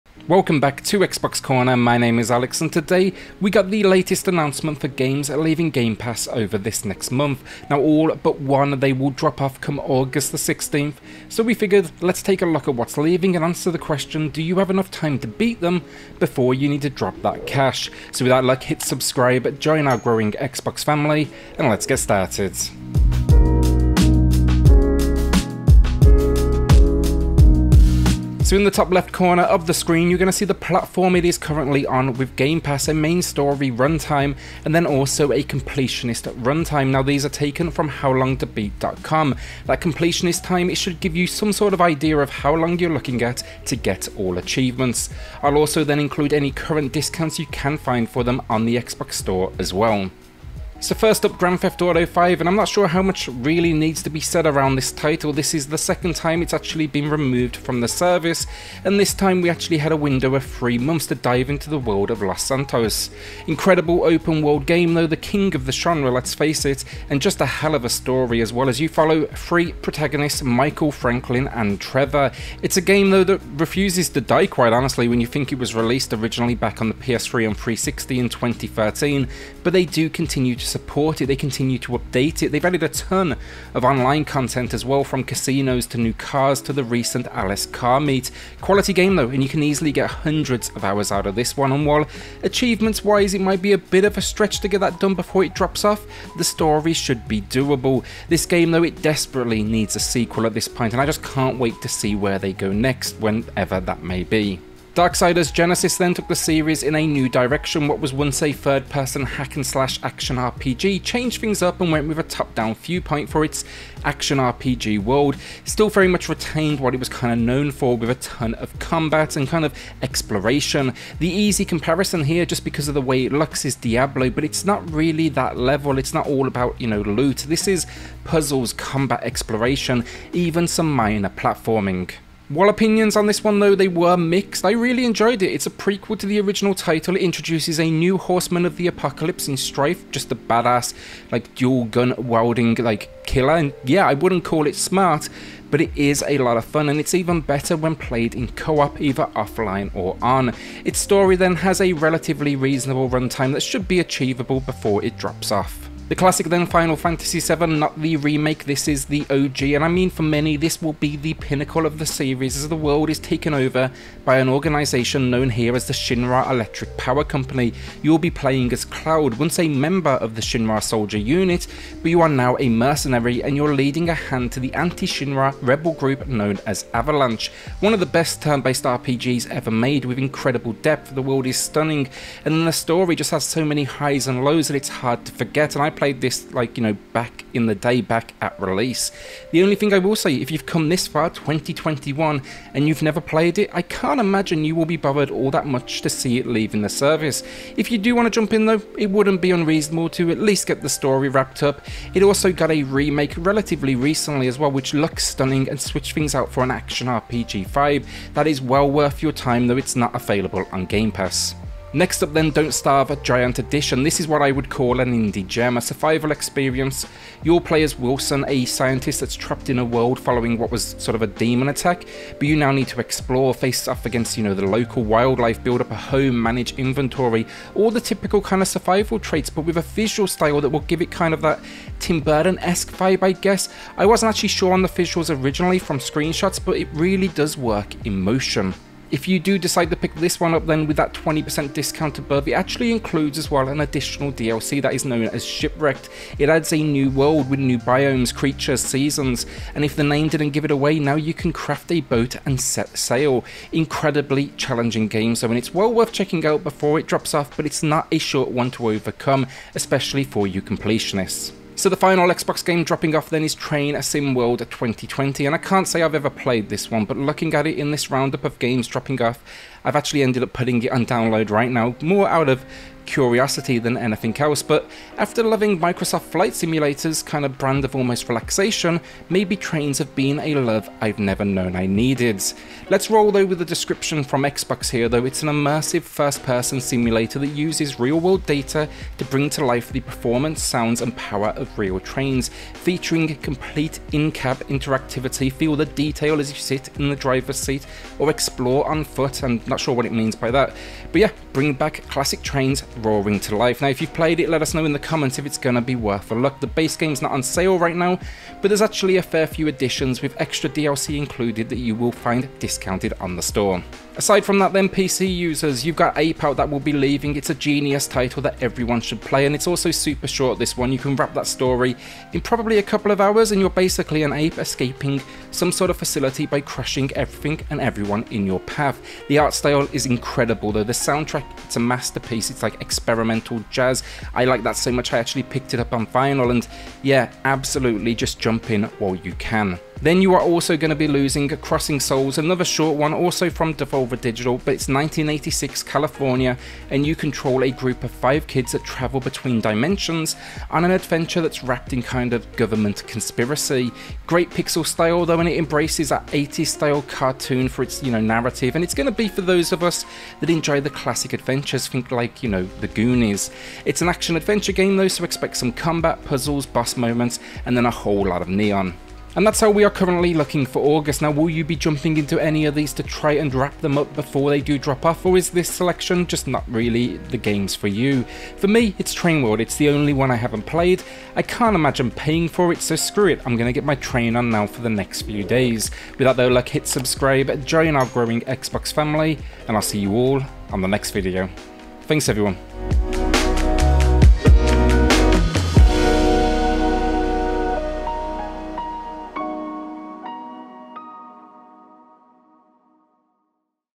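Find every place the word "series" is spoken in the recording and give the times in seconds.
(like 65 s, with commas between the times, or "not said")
106 s, 162 s.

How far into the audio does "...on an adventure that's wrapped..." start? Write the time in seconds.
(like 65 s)
350 s.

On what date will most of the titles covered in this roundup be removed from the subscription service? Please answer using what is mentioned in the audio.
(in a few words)
August 16.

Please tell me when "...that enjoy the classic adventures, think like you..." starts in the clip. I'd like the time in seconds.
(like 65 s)
360 s.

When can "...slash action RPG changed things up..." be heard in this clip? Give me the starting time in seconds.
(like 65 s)
109 s.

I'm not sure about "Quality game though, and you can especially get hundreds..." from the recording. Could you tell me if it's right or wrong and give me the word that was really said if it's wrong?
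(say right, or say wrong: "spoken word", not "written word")
wrong: "easily", not "especially".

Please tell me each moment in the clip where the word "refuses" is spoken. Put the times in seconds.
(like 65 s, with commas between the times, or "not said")
73 s.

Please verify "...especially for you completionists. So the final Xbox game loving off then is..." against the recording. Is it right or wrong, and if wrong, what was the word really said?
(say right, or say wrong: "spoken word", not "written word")
wrong: "dropping", not "loving".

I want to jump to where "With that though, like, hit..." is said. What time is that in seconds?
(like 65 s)
386 s.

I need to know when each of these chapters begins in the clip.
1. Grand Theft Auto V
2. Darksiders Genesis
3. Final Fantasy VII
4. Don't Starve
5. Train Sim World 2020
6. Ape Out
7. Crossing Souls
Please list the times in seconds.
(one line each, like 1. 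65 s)
1. 51 s
2. 104 s
3. 156 s
4. 212 s
5. 263 s
6. 315 s
7. 341 s.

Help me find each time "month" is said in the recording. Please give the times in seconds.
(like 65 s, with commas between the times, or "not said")
7 s, 60 s.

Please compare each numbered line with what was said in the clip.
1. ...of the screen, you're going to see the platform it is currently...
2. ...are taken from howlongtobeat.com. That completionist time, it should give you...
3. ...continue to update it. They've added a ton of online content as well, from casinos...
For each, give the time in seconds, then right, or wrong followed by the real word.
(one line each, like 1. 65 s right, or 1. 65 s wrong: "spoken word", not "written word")
1. 29 s right
2. 37 s right
3. 81 s right.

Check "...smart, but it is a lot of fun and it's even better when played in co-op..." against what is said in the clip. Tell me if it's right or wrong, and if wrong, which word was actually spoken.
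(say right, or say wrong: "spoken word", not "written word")
right.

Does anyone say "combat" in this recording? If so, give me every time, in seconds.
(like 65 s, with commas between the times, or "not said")
118 s, 128 s, 365 s.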